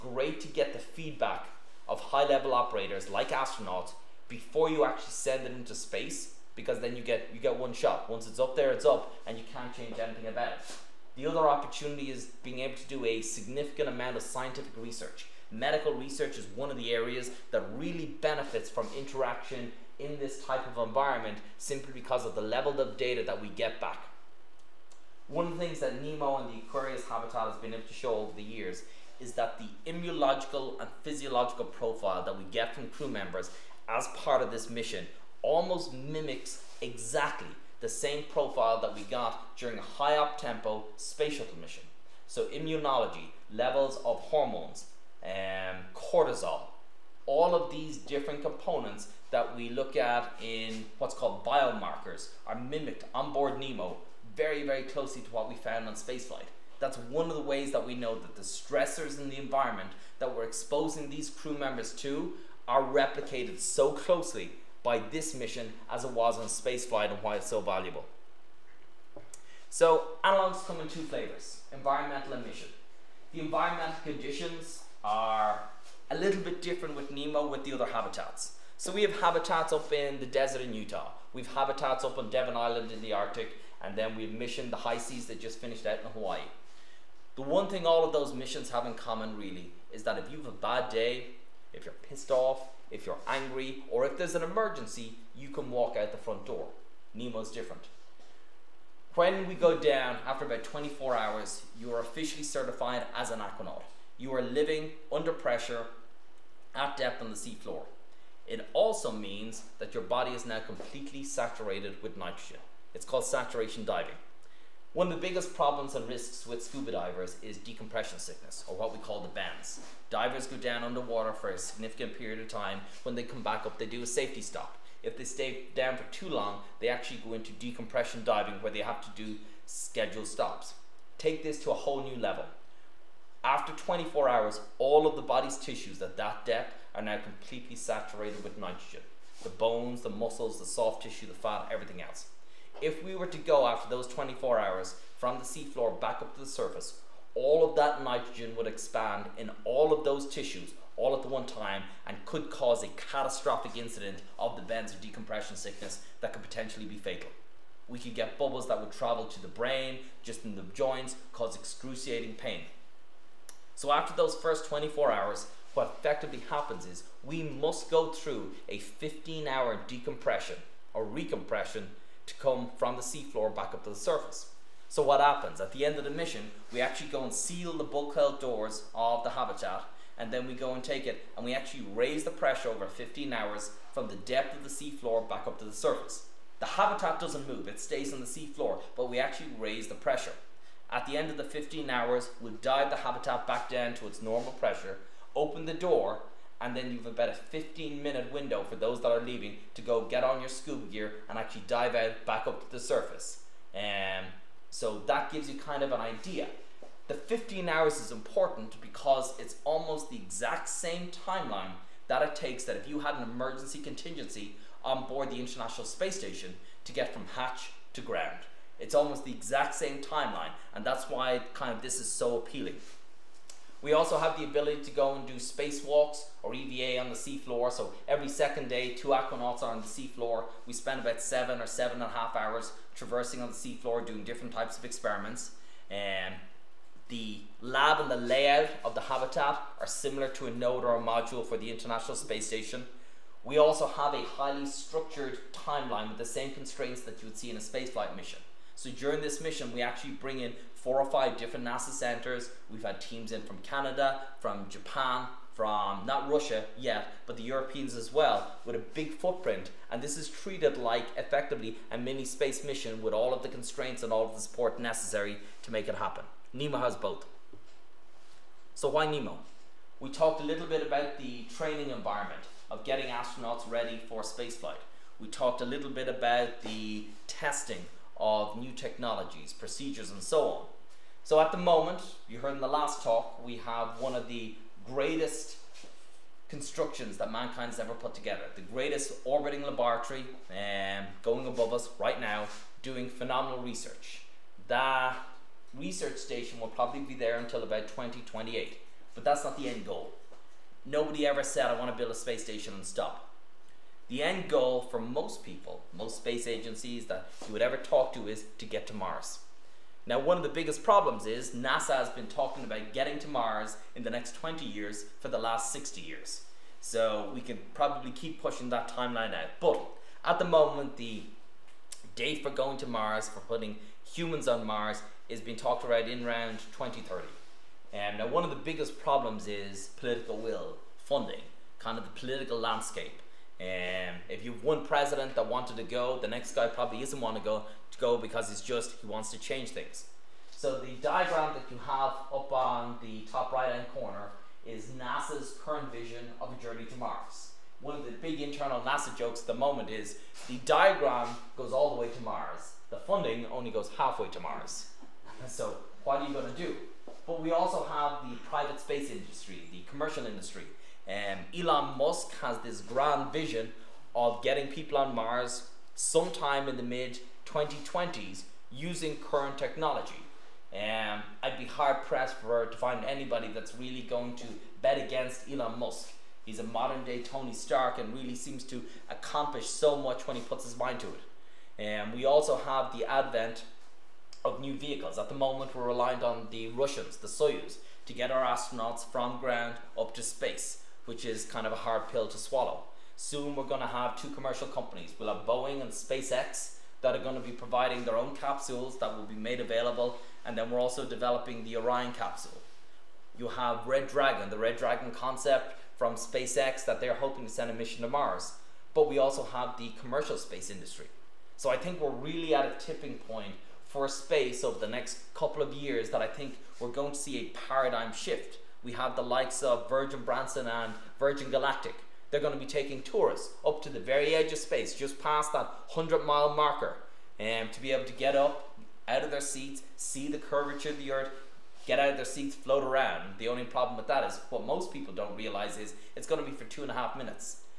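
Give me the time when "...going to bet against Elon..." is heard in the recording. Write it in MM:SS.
06:14.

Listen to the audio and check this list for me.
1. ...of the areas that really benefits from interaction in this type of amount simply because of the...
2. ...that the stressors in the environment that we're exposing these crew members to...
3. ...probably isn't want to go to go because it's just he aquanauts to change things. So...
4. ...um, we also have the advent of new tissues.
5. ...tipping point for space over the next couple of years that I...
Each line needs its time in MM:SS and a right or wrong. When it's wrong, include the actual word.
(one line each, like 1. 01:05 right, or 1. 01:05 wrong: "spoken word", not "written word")
1. 00:16 wrong: "environment", not "amount"
2. 00:58 right
3. 05:36 wrong: "wants", not "aquanauts"
4. 06:22 wrong: "vehicles", not "tissues"
5. 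06:52 right.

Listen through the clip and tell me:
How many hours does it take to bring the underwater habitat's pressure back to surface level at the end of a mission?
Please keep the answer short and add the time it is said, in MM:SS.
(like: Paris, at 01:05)
15 hours, at 02:48.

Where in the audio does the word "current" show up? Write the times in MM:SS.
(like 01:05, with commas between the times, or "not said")
05:45, 06:09.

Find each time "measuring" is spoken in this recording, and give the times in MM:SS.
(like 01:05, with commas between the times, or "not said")
not said.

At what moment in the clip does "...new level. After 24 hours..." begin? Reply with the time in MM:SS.
02:12.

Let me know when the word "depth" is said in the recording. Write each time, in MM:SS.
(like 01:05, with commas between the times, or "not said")
01:46, 02:16, 03:04.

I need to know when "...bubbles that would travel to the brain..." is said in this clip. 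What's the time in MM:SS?
02:38.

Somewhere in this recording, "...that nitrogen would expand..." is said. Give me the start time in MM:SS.
02:27.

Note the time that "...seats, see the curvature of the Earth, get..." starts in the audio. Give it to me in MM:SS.
07:09.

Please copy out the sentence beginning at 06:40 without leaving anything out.
And then we're also developing the Orion capsule.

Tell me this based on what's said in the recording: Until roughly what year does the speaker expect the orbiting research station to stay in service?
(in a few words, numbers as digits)
2028.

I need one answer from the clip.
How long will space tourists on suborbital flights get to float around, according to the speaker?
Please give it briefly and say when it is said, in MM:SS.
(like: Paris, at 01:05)
two and a half minutes, at 07:16.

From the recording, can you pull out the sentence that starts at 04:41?
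So at the moment, you heard in the last talk, we have one of the greatest constructions that mankind's ever put together.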